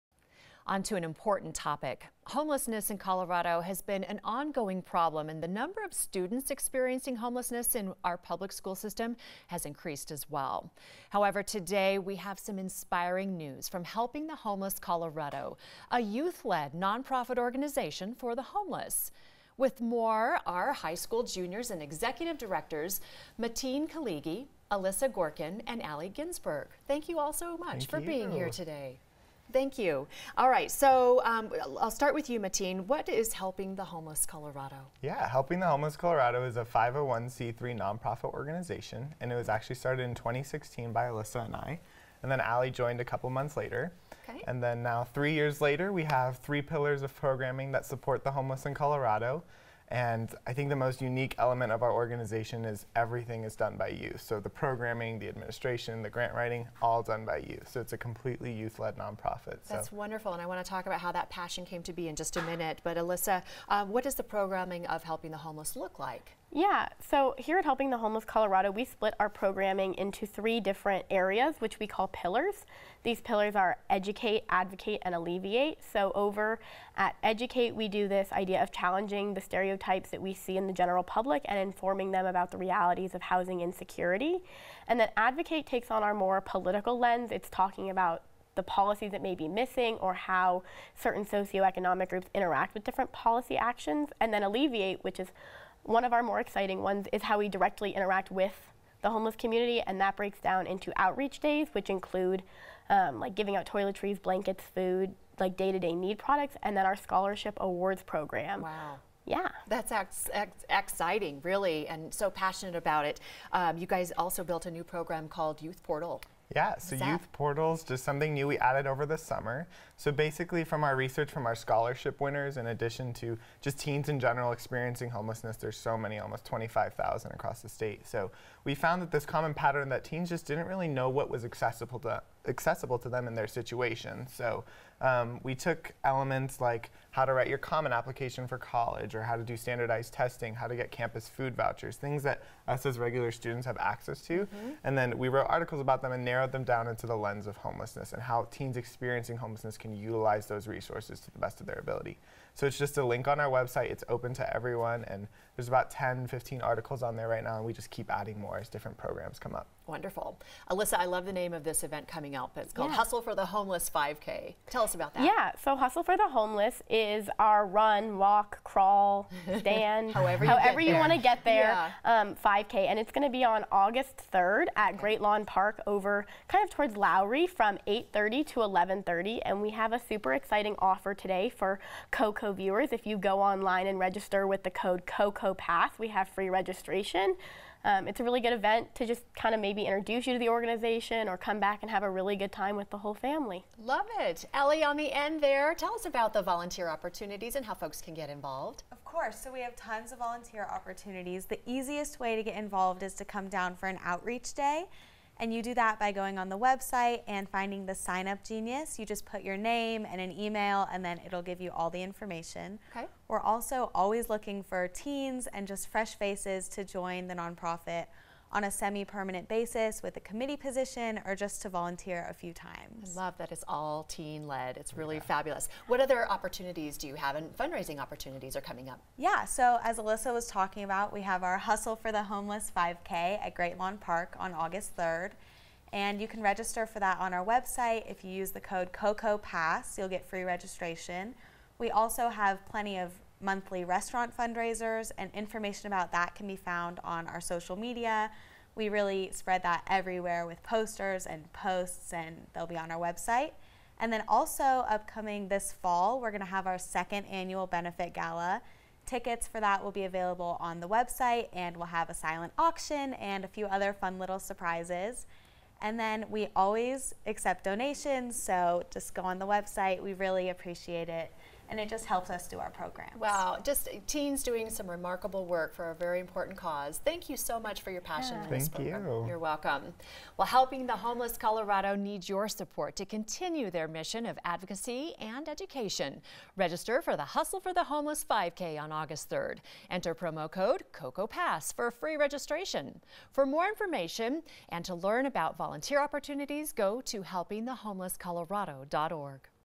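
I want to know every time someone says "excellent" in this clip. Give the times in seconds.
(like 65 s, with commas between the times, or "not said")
not said.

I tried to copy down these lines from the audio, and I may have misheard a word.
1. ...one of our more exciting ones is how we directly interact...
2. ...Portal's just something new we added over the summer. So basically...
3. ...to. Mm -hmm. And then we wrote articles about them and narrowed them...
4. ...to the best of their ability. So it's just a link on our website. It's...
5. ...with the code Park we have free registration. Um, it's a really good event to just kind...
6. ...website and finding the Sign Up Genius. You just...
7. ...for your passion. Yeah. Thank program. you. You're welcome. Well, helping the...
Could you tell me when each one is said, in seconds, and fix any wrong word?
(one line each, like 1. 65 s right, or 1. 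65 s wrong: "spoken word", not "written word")
1. 95 s right
2. 117 s right
3. 144 s right
4. 151 s right
5. 184 s wrong: "COCO", not "Park"
6. 206 s right
7. 277 s right.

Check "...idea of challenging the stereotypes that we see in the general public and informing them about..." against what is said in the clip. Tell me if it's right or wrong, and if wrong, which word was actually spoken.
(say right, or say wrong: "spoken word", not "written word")
right.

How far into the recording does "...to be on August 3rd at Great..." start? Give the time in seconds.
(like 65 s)
173 s.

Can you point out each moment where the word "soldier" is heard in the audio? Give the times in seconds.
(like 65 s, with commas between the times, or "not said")
not said.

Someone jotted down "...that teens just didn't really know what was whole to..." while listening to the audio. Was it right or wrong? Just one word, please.
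wrong.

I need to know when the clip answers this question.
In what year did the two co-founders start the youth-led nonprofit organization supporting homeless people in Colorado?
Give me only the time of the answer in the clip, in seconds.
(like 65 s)
40 s.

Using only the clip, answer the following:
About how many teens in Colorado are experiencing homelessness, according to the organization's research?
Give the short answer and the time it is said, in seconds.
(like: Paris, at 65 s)
25,000, at 126 s.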